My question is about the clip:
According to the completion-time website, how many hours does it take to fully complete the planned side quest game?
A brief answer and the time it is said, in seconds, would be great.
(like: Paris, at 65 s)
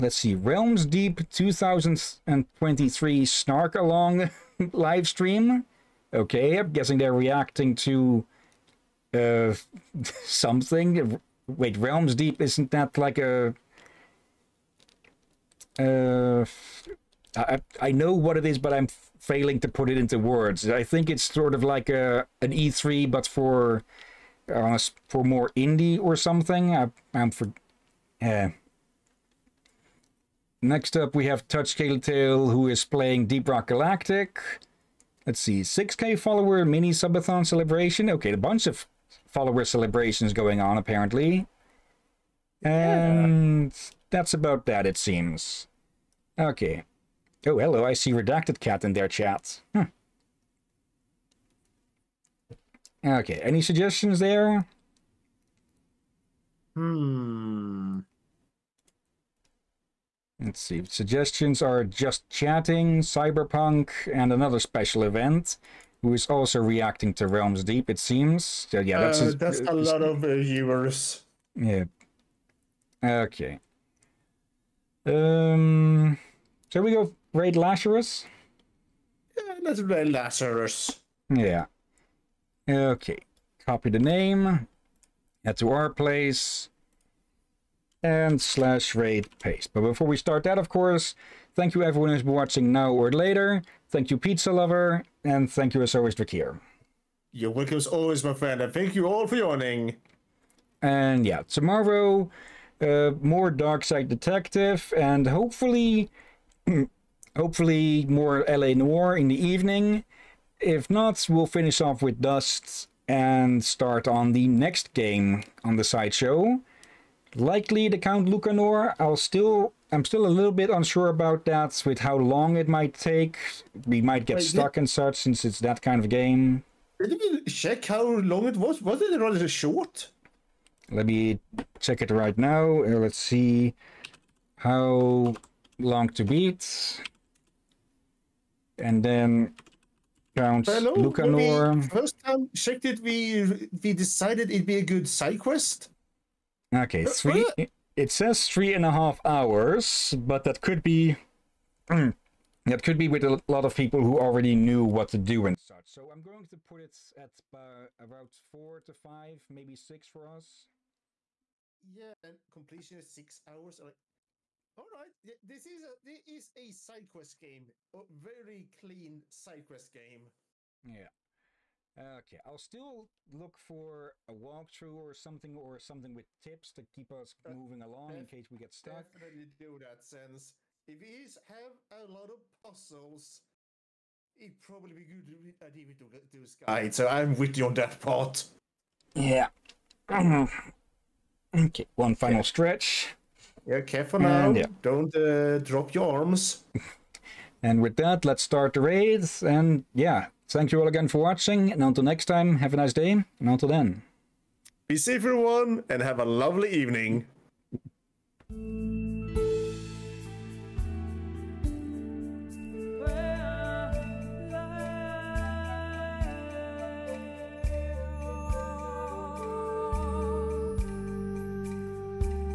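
6, at 163 s.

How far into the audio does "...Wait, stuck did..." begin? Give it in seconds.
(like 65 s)
124 s.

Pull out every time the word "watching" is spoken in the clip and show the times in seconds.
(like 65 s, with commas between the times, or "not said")
92 s, 201 s.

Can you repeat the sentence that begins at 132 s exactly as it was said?
Uh, let's see how long to beat.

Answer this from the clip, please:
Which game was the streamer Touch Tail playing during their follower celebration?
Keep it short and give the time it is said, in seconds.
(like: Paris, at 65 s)
Deep Rock Galactic, at 33 s.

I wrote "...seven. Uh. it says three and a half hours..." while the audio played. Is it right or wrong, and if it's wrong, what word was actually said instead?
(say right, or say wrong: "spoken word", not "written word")
wrong: "three", not "seven".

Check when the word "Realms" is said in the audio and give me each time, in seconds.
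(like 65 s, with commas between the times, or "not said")
0 s, 11 s, 67 s.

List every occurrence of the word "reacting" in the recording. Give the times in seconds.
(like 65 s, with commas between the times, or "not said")
7 s, 66 s.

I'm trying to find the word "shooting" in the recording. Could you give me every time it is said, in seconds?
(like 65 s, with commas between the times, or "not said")
not said.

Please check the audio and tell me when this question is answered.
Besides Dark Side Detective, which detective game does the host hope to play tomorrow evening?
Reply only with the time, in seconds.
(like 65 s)
108 s.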